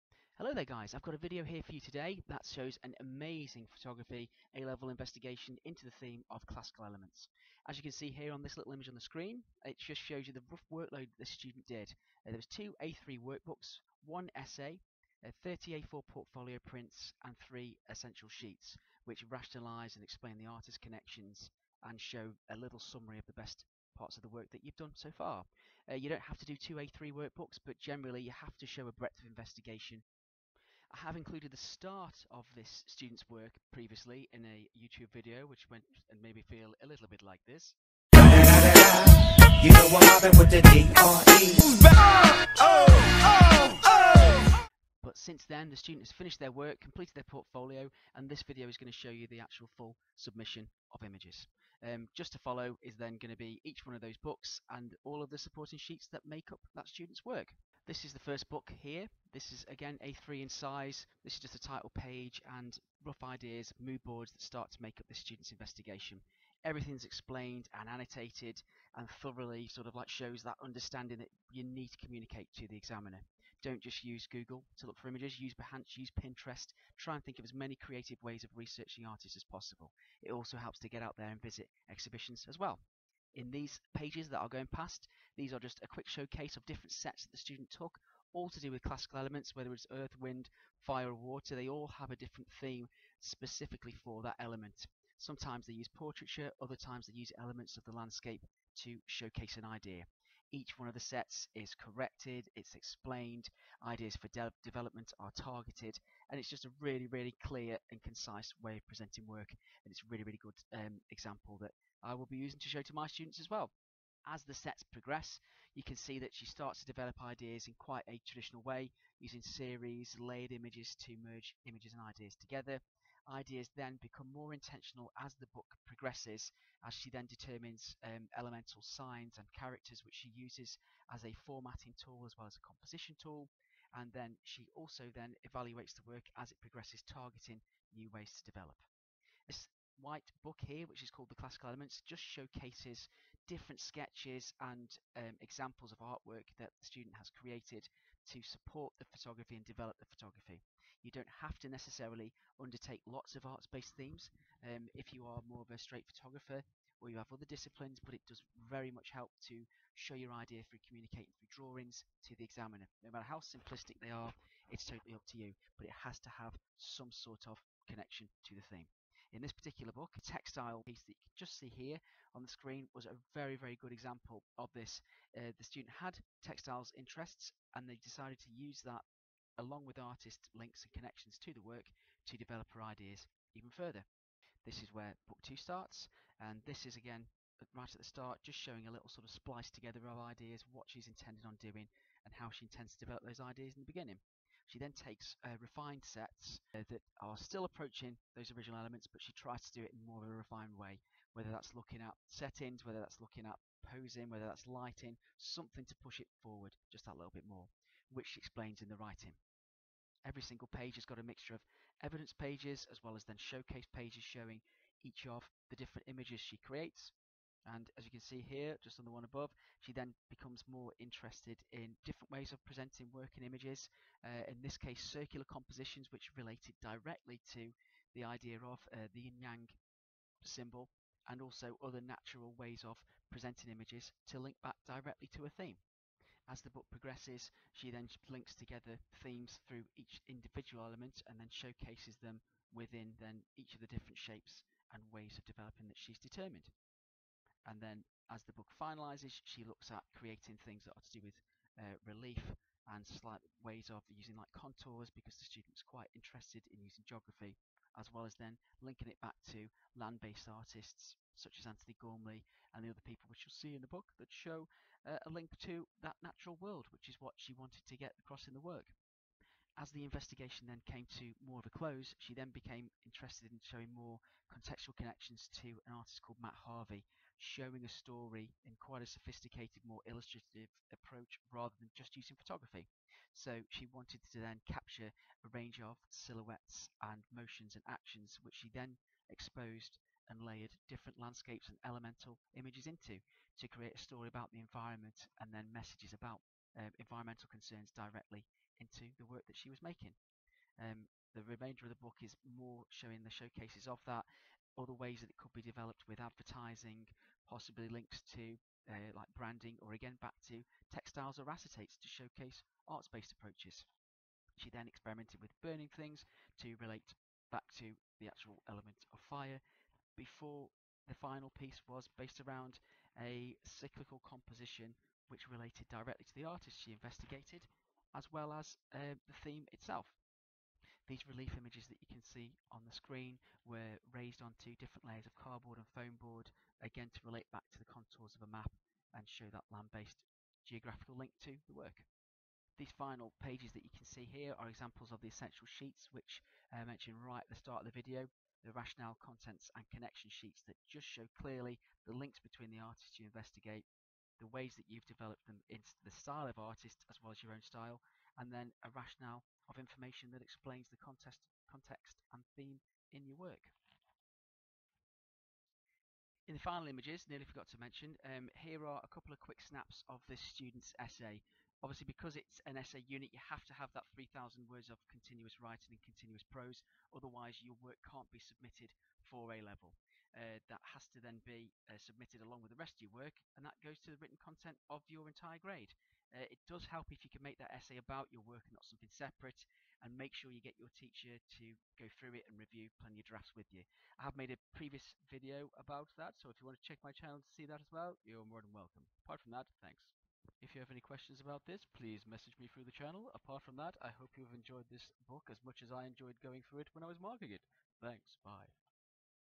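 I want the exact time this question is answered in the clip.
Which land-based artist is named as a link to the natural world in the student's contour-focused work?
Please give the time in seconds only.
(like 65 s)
261 s.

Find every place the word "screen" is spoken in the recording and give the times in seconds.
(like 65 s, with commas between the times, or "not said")
9 s, 172 s, 332 s.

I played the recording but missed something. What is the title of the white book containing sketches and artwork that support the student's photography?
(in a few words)
The Classical Elements.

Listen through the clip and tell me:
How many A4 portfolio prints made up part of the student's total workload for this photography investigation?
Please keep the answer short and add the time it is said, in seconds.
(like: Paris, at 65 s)
30, at 15 s.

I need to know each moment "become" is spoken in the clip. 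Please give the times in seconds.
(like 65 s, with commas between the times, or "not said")
124 s, 220 s.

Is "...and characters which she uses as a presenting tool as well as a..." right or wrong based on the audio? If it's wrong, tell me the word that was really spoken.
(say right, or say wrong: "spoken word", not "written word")
wrong: "formatting", not "presenting".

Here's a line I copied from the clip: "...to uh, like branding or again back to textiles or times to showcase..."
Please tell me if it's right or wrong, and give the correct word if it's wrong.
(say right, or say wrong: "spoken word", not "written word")
wrong: "acetates", not "times".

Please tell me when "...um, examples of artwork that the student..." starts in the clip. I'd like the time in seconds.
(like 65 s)
145 s.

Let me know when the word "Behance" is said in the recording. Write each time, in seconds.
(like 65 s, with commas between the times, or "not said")
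75 s.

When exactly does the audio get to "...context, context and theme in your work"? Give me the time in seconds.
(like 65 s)
361 s.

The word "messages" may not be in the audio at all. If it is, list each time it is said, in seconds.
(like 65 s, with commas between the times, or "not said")
295 s, 402 s.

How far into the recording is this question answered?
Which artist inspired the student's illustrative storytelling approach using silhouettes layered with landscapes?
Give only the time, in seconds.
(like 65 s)
276 s.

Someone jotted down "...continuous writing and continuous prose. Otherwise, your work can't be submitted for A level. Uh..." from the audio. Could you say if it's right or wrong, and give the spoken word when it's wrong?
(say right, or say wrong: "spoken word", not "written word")
right.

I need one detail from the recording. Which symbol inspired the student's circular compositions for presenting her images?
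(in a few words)
yin-yang.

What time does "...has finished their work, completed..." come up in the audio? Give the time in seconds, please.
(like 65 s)
46 s.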